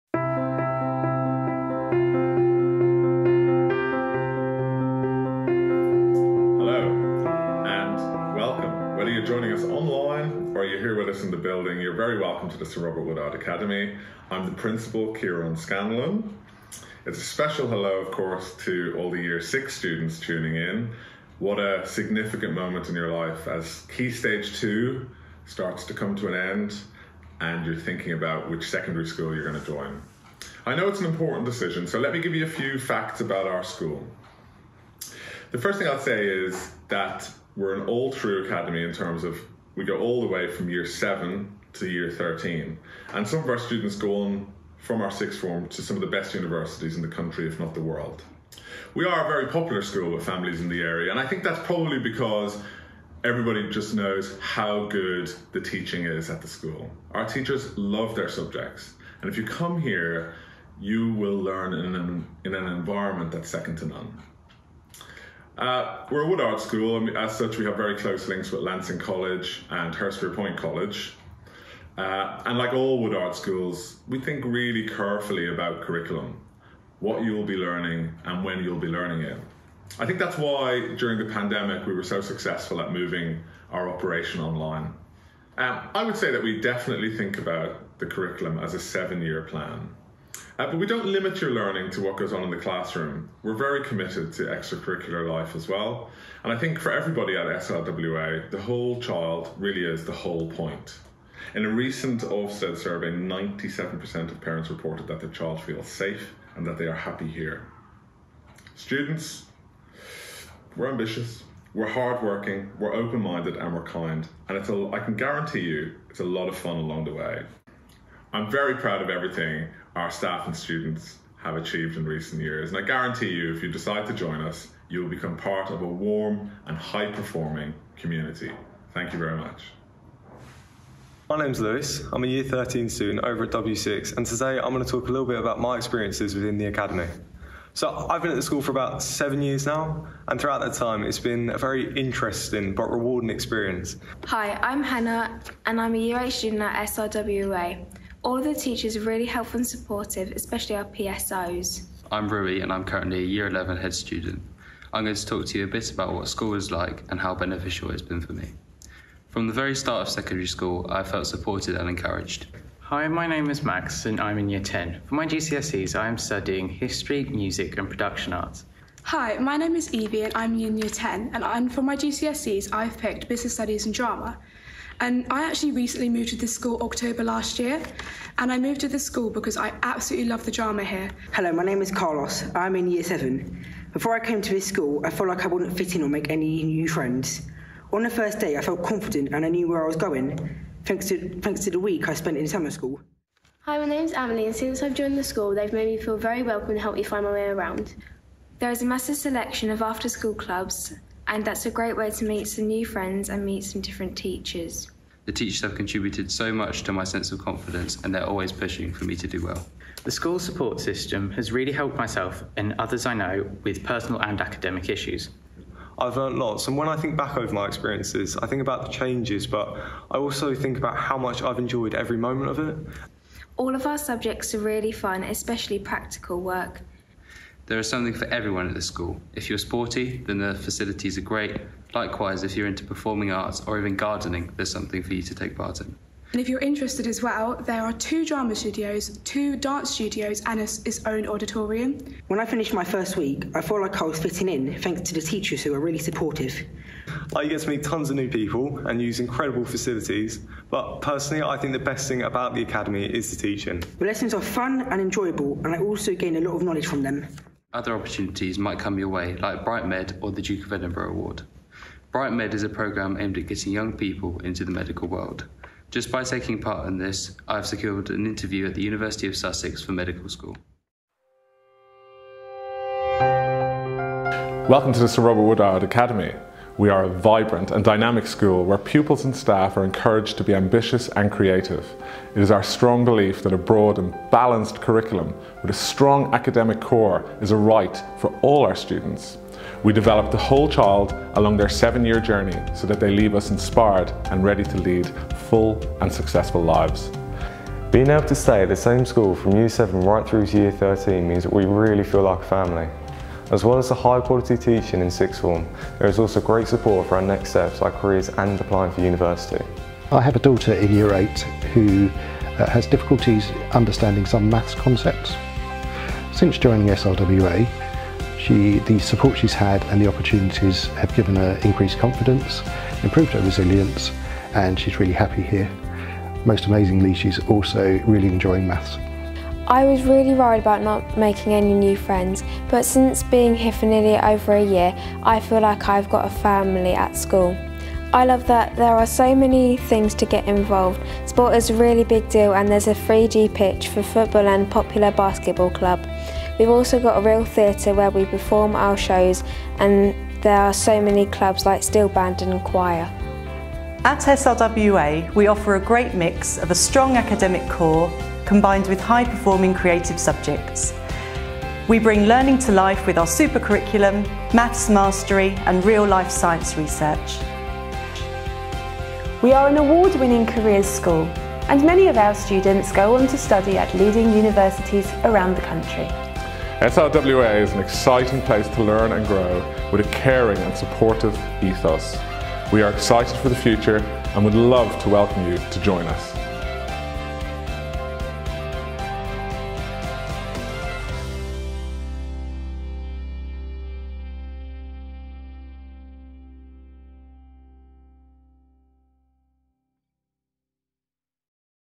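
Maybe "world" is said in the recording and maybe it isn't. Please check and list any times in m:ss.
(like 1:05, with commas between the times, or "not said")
0:47, 4:25.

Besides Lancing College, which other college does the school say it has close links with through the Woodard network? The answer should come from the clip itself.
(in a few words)
Hurstpierpoint College.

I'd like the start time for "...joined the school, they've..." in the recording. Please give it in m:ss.
3:14.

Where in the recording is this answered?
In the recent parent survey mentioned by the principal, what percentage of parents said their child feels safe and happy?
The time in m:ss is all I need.
1:43.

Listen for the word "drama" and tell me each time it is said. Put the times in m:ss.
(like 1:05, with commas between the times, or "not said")
2:53, 3:00, 3:58.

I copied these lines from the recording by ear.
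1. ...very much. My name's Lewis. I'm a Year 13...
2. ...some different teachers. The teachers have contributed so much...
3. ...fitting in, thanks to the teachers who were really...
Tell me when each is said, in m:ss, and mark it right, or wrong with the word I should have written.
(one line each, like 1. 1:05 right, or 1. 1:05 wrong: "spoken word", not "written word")
1. 2:09 right
2. 3:23 right
3. 4:04 right.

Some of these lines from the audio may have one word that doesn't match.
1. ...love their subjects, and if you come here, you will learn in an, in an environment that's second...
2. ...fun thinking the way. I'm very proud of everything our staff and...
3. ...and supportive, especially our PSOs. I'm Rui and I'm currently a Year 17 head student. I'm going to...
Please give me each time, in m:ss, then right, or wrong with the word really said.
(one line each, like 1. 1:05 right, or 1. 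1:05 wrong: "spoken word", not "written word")
1. 0:57 right
2. 1:56 wrong: "along", not "thinking"
3. 2:29 wrong: "11", not "17".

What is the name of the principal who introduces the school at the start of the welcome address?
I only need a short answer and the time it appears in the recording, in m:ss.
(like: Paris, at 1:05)
Kieran Scanlon, at 0:15.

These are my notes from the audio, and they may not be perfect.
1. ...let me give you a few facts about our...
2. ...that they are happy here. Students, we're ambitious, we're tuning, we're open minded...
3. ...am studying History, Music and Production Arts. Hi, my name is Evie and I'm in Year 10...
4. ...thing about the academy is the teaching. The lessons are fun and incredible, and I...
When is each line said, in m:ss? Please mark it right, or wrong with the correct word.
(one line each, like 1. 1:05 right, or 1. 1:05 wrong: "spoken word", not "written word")
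1. 0:31 right
2. 1:46 wrong: "hardworking", not "tuning"
3. 2:46 right
4. 4:12 wrong: "enjoyable", not "incredible".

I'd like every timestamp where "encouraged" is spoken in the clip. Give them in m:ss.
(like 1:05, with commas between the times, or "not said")
2:41, 4:39.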